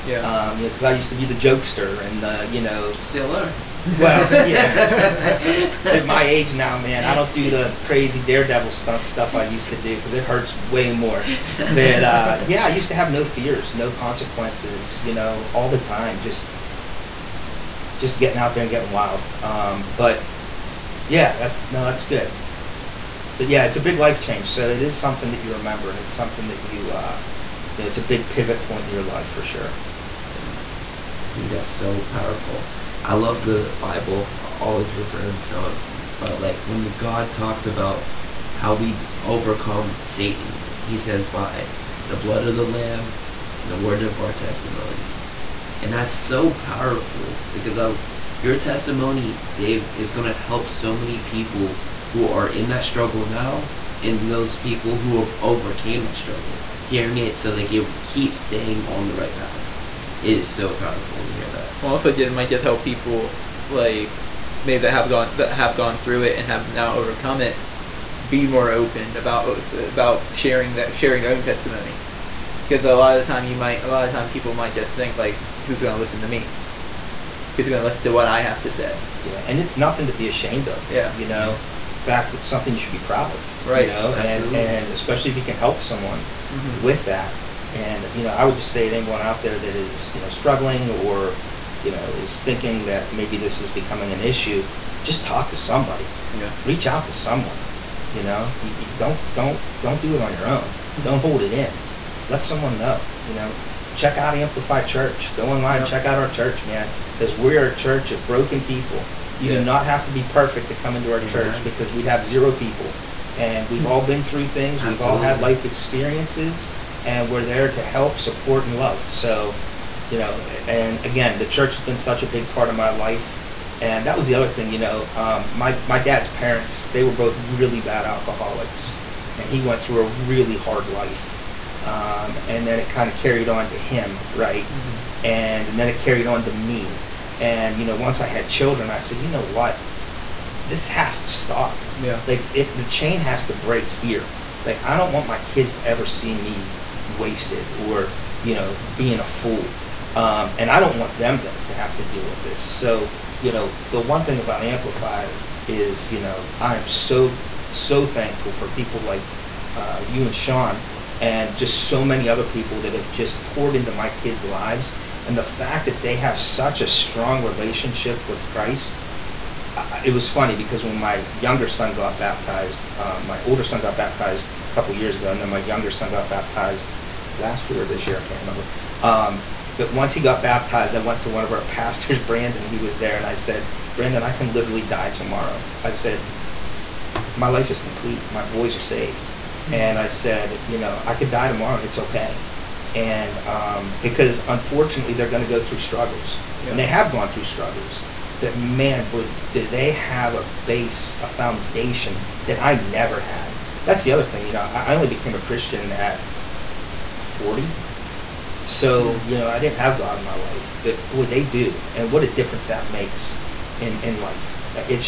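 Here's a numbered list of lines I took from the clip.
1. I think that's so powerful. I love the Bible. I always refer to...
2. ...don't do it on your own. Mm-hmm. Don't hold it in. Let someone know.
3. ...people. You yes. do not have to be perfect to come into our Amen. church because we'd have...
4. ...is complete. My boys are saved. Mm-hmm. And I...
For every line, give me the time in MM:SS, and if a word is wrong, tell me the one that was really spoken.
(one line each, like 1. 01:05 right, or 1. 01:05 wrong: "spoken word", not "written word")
1. 00:31 right
2. 01:39 right
3. 01:48 right
4. 03:07 right.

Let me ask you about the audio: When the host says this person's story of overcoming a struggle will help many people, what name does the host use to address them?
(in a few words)
Dave.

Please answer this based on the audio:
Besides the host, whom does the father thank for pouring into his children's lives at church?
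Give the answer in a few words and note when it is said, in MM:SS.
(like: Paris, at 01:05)
Shawn, at 02:40.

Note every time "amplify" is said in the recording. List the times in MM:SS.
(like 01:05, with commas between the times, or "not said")
01:44, 02:34.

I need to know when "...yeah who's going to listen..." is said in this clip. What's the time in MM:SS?
01:17.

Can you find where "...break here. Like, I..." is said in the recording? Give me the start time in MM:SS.
02:23.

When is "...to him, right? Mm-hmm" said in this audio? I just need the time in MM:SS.
02:13.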